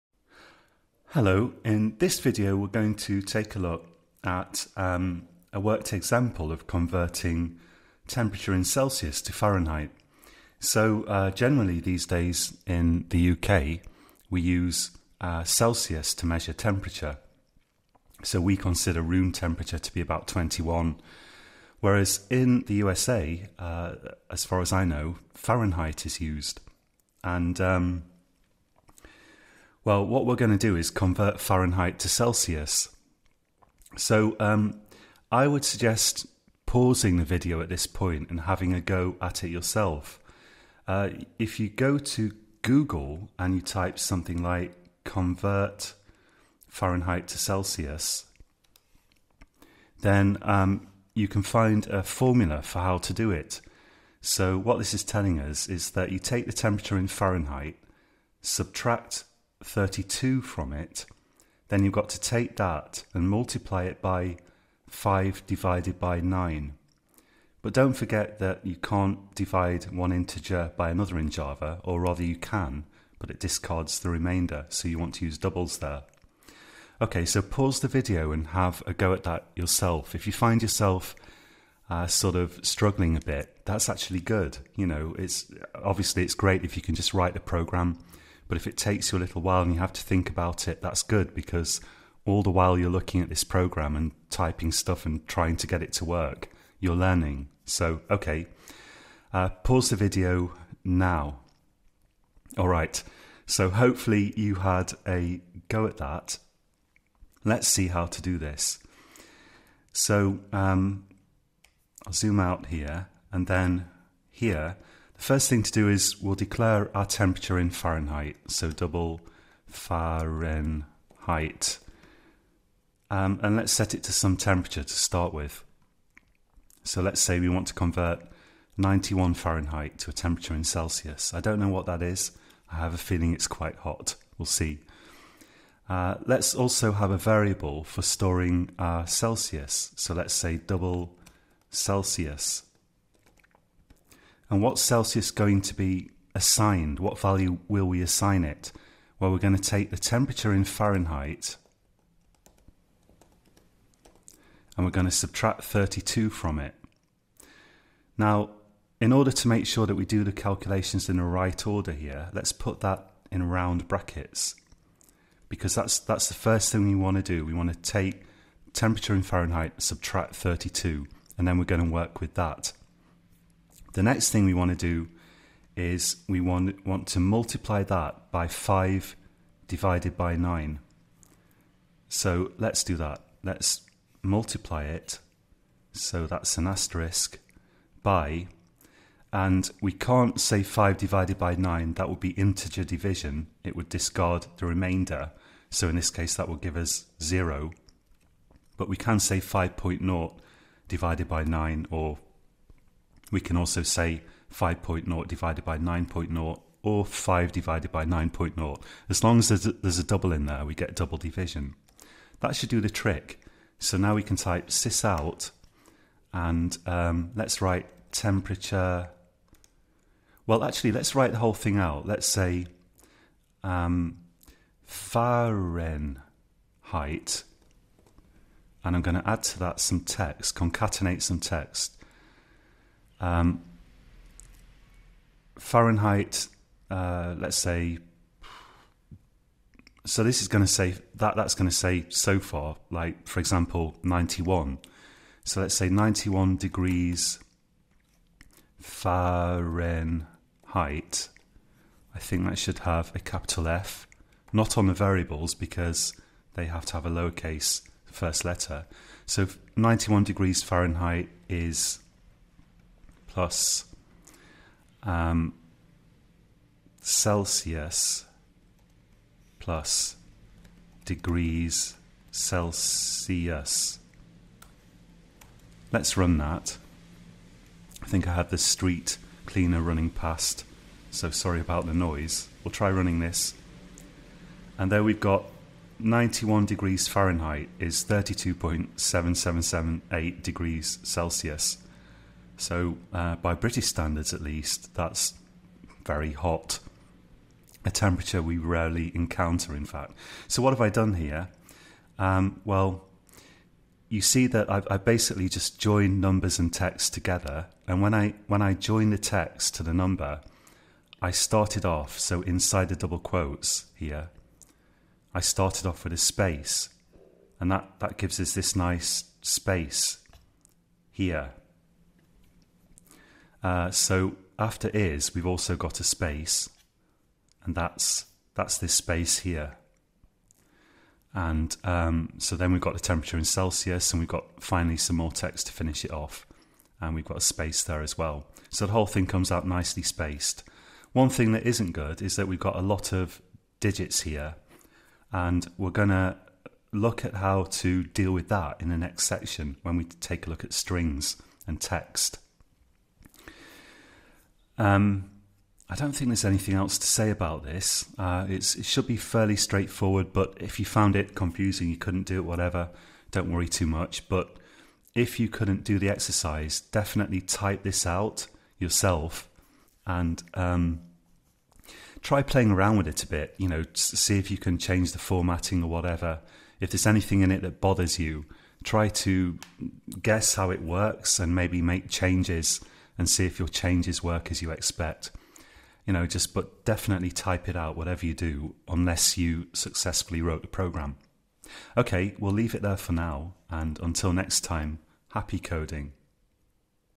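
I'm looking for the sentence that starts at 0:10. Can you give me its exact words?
So uh, generally these days in the UK we use uh, Celsius to measure temperature.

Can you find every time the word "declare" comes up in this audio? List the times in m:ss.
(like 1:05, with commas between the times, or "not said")
1:56.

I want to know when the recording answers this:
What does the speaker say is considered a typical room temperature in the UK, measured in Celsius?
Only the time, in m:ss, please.
0:20.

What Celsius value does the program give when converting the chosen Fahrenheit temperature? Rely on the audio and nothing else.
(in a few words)
32.7778.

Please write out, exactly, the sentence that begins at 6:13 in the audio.
You know, see if you can change the formatting or whatever.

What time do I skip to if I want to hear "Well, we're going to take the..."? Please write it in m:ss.
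2:29.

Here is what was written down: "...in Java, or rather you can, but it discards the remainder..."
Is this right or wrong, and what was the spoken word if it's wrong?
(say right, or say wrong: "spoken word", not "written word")
right.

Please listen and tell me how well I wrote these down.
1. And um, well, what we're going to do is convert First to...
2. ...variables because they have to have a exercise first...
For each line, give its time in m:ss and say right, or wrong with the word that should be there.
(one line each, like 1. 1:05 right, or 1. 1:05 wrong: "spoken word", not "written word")
1. 0:27 wrong: "Fahrenheit", not "First"
2. 4:14 wrong: "lowercase", not "exercise".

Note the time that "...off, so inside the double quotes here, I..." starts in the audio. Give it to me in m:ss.
5:11.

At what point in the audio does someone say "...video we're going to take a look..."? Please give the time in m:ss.
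0:02.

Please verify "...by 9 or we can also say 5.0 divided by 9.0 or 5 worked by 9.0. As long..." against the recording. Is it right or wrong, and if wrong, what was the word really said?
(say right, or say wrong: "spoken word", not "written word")
wrong: "divided", not "worked".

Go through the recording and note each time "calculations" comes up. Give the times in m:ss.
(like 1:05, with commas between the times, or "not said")
2:40.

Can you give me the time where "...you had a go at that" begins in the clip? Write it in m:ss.
1:44.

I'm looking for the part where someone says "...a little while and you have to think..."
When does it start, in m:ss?
1:29.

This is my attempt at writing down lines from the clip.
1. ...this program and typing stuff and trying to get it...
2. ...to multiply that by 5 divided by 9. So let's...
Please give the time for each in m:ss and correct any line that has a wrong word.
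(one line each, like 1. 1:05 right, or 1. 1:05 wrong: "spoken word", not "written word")
1. 1:33 right
2. 2:57 right.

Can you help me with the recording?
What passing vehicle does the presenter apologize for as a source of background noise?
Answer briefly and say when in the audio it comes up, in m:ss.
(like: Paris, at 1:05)
street cleaner, at 4:38.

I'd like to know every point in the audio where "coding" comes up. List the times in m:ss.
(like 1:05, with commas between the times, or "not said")
6:35.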